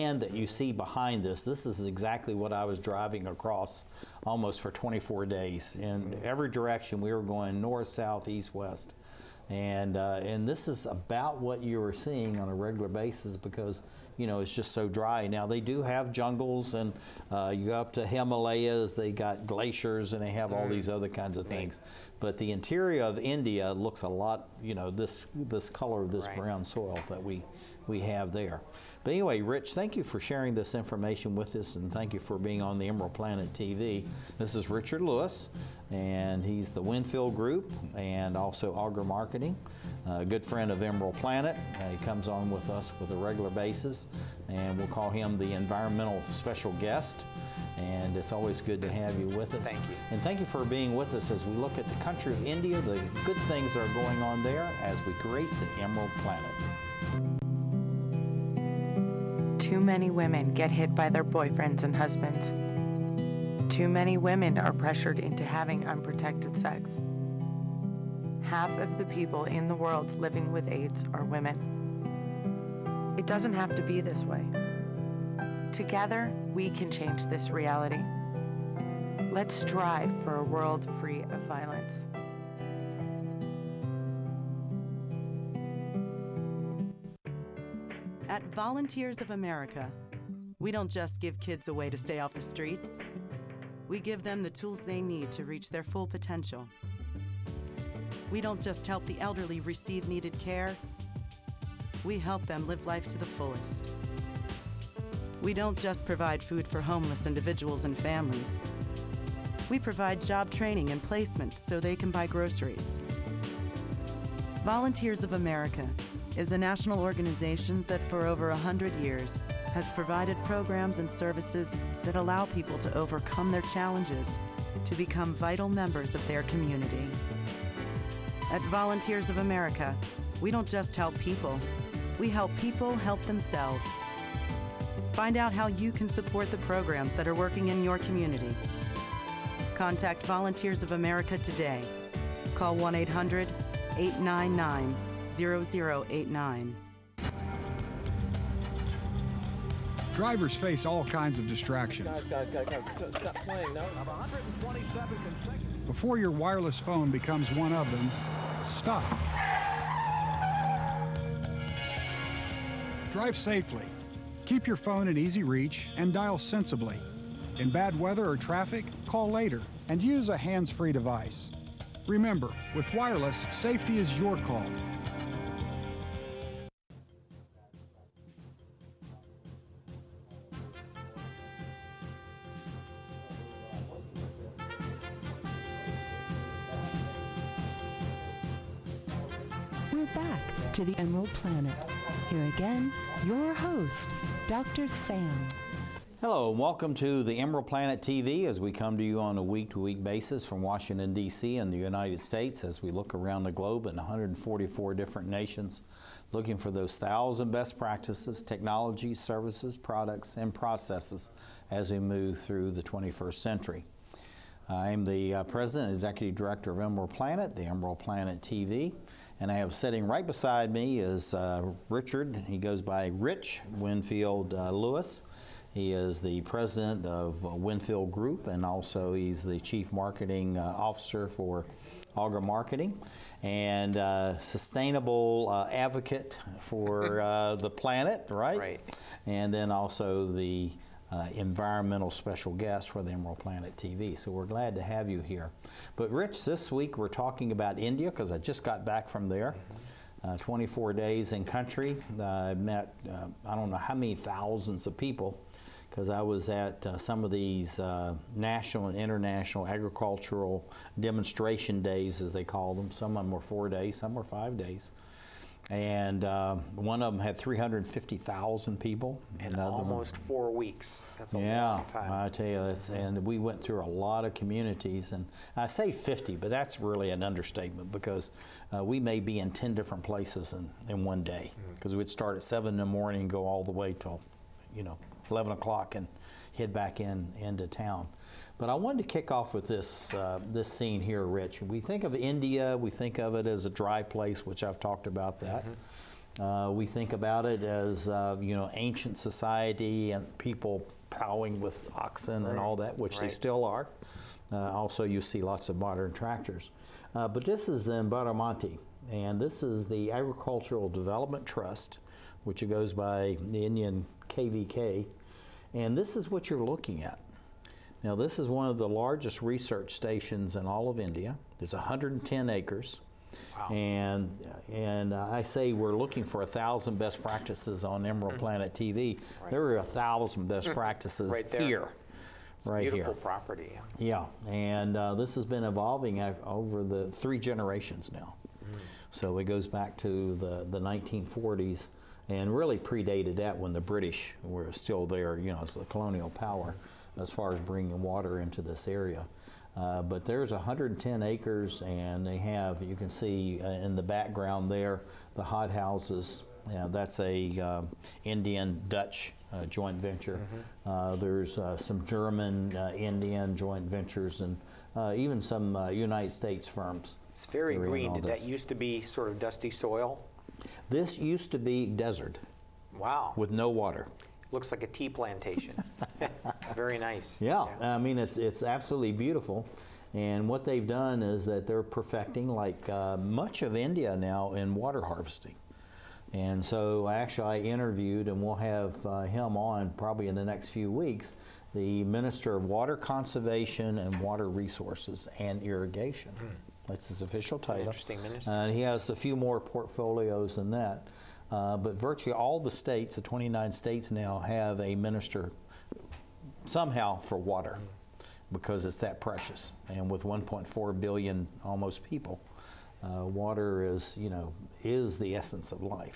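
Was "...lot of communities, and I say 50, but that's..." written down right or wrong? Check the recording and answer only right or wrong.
right.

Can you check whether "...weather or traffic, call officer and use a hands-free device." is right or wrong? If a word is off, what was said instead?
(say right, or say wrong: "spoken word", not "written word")
wrong: "later", not "officer".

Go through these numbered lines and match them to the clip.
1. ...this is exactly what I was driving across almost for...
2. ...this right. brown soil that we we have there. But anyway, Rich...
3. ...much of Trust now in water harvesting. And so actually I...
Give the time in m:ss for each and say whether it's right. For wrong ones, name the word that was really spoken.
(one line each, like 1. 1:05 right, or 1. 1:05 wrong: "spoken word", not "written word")
1. 0:01 right
2. 0:26 right
3. 6:23 wrong: "India", not "Trust".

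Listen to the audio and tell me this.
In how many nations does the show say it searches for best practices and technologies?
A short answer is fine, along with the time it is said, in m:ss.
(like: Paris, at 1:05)
144, at 3:23.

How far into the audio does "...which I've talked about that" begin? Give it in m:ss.
4:54.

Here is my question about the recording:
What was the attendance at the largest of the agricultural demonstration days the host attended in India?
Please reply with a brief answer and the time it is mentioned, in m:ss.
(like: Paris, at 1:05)
350,000, at 4:27.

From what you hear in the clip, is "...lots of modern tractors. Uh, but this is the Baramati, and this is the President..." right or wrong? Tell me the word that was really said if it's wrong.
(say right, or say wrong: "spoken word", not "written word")
wrong: "Agricultural", not "President".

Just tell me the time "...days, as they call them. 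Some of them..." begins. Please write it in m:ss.
4:21.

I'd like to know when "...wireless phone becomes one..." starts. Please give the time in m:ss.
2:36.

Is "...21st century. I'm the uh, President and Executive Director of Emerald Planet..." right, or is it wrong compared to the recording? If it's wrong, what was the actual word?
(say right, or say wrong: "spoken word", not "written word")
right.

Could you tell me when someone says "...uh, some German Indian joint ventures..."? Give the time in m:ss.
6:01.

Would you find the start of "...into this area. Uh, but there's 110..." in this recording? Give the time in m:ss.
5:48.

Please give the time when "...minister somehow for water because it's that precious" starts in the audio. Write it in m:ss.
6:44.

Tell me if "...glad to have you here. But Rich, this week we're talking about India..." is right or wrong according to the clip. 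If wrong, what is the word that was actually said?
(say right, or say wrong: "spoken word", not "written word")
right.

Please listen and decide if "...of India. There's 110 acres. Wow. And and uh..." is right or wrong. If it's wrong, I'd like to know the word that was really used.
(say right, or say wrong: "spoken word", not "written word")
right.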